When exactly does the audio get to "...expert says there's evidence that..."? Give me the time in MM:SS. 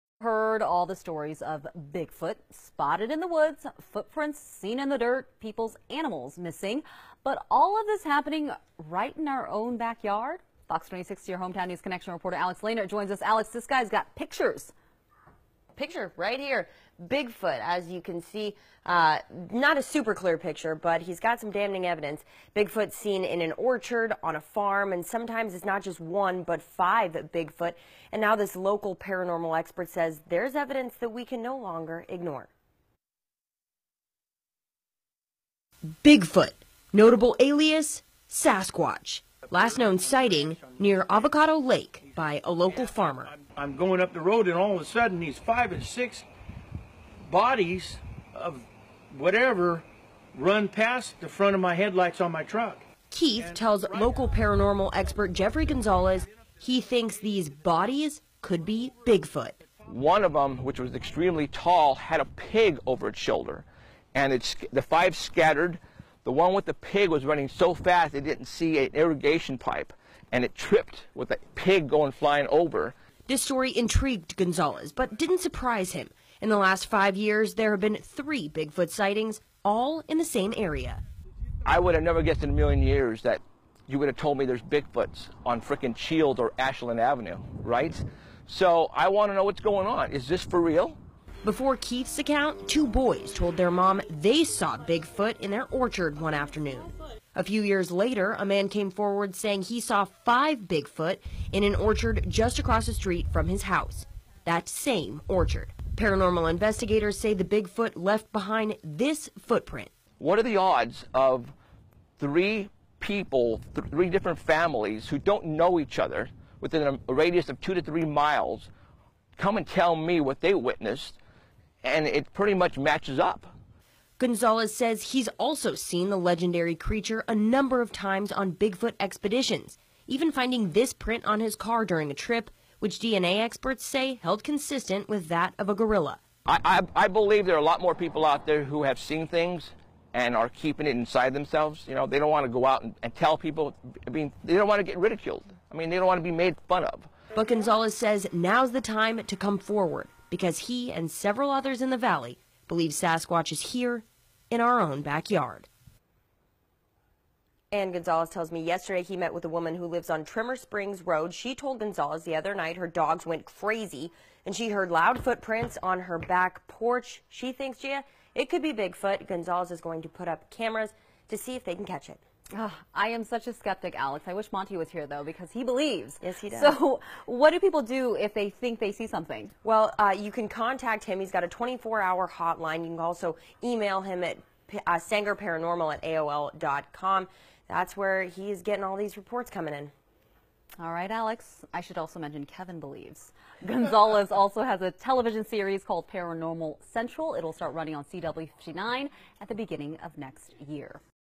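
00:29.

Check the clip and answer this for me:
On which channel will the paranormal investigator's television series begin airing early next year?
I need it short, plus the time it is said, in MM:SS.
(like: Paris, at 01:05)
CW59, at 03:18.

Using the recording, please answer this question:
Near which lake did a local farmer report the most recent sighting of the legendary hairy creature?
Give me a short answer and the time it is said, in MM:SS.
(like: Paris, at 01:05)
Avocado Lake, at 00:41.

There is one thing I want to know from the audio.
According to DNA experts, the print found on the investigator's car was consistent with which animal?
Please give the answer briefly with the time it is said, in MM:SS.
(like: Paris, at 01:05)
Gorilla, at 02:15.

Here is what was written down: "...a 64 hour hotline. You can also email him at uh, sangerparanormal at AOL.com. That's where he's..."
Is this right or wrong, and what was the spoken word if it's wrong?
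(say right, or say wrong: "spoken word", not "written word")
wrong: "24", not "64".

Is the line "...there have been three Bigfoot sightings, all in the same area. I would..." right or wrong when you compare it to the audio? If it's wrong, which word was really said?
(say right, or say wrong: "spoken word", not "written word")
right.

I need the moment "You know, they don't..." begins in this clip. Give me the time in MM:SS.
02:21.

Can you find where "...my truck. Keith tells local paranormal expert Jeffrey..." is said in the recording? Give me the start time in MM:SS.
00:52.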